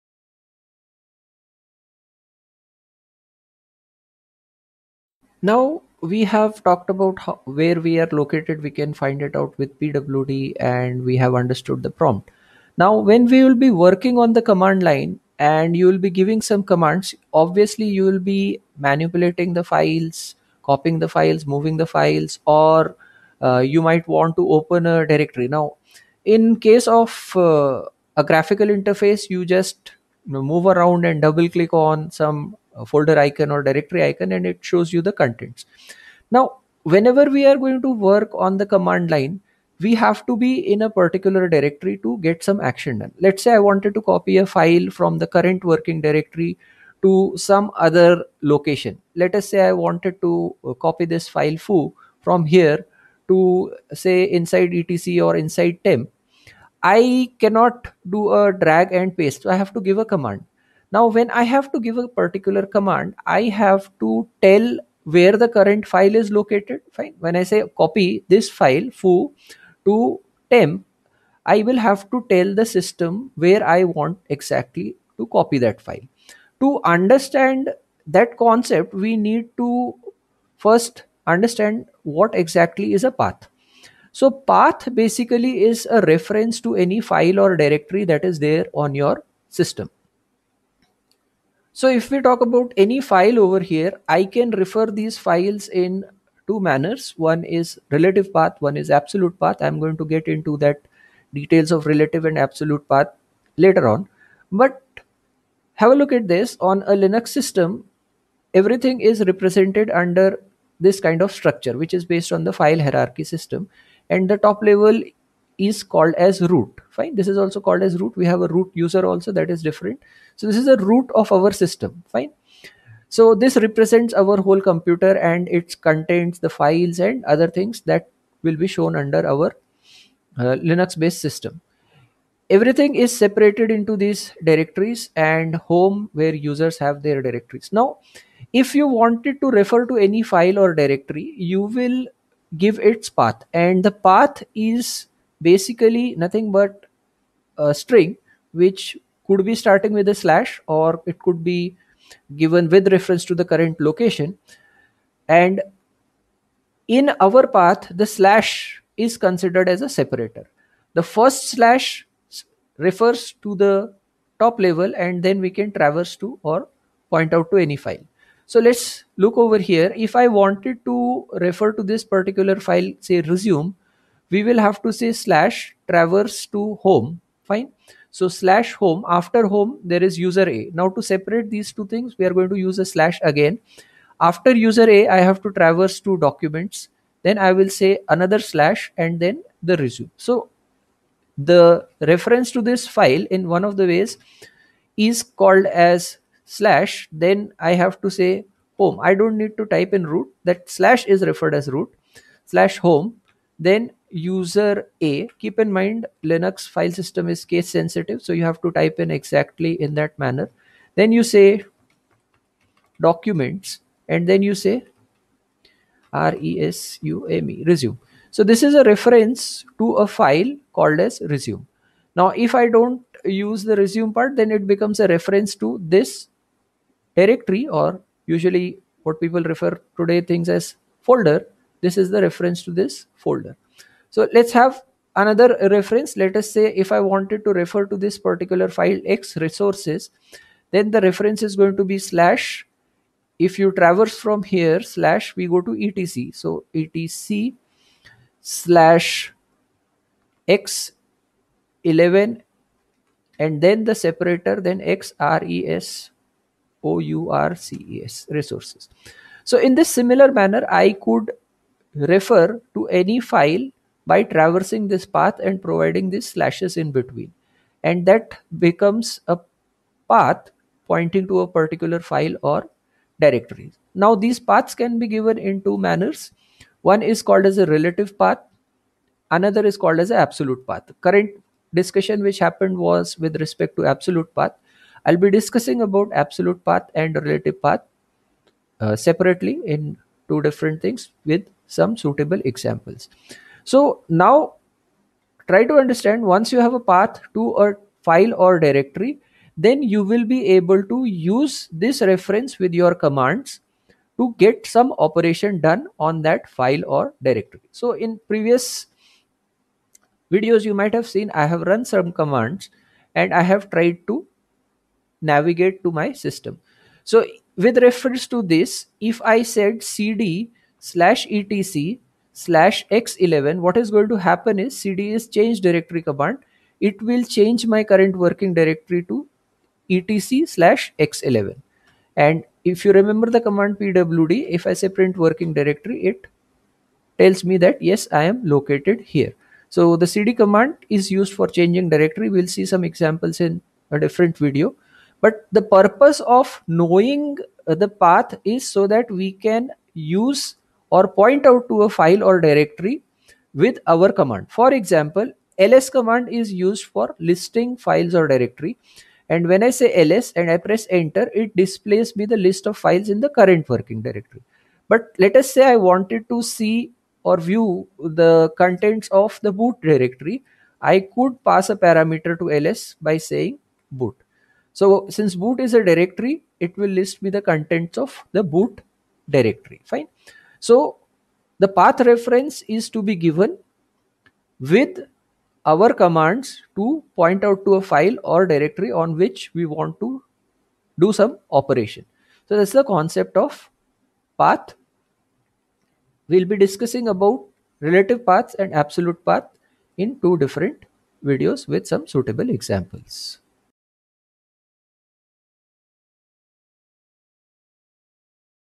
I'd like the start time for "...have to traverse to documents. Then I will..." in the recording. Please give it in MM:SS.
03:05.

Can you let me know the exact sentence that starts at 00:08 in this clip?
We can find it out with pwd and we have understood the prompt.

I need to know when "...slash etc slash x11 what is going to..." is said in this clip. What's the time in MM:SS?
05:20.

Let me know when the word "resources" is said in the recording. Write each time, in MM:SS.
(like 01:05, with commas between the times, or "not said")
03:59, 04:18.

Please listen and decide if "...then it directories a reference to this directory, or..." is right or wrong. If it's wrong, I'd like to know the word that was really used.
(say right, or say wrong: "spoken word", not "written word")
wrong: "becomes", not "directories".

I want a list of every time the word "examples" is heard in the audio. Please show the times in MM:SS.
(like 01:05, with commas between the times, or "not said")
04:52, 05:42, 05:54, 06:42.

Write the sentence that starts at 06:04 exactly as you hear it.
But let us say I wanted to see or view the contents of the boot directory.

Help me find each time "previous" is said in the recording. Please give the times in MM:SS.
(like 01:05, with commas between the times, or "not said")
05:08.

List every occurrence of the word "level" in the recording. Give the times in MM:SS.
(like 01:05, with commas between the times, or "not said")
01:54, 02:44.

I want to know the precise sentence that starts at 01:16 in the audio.
To understand that concept, we need to first understand what exactly is a path.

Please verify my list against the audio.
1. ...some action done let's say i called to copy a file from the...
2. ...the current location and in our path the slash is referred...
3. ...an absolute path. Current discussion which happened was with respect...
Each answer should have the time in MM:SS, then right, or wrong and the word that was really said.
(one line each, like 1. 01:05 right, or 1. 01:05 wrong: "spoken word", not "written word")
1. 00:42 wrong: "wanted", not "called"
2. 02:33 wrong: "considered", not "referred"
3. 04:40 right.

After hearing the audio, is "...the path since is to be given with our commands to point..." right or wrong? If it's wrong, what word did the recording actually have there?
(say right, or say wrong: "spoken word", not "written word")
wrong: "reference", not "since".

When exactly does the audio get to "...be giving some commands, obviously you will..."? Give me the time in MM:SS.
00:15.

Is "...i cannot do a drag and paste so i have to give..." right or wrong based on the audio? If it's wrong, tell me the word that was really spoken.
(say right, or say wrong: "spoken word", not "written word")
right.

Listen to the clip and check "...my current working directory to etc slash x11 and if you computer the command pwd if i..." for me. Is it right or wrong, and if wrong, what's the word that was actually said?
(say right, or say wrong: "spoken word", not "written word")
wrong: "remember", not "computer".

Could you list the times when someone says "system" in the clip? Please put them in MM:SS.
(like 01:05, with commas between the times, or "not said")
01:12, 01:29, 01:47, 01:53, 02:01, 02:11, 03:26, 05:16.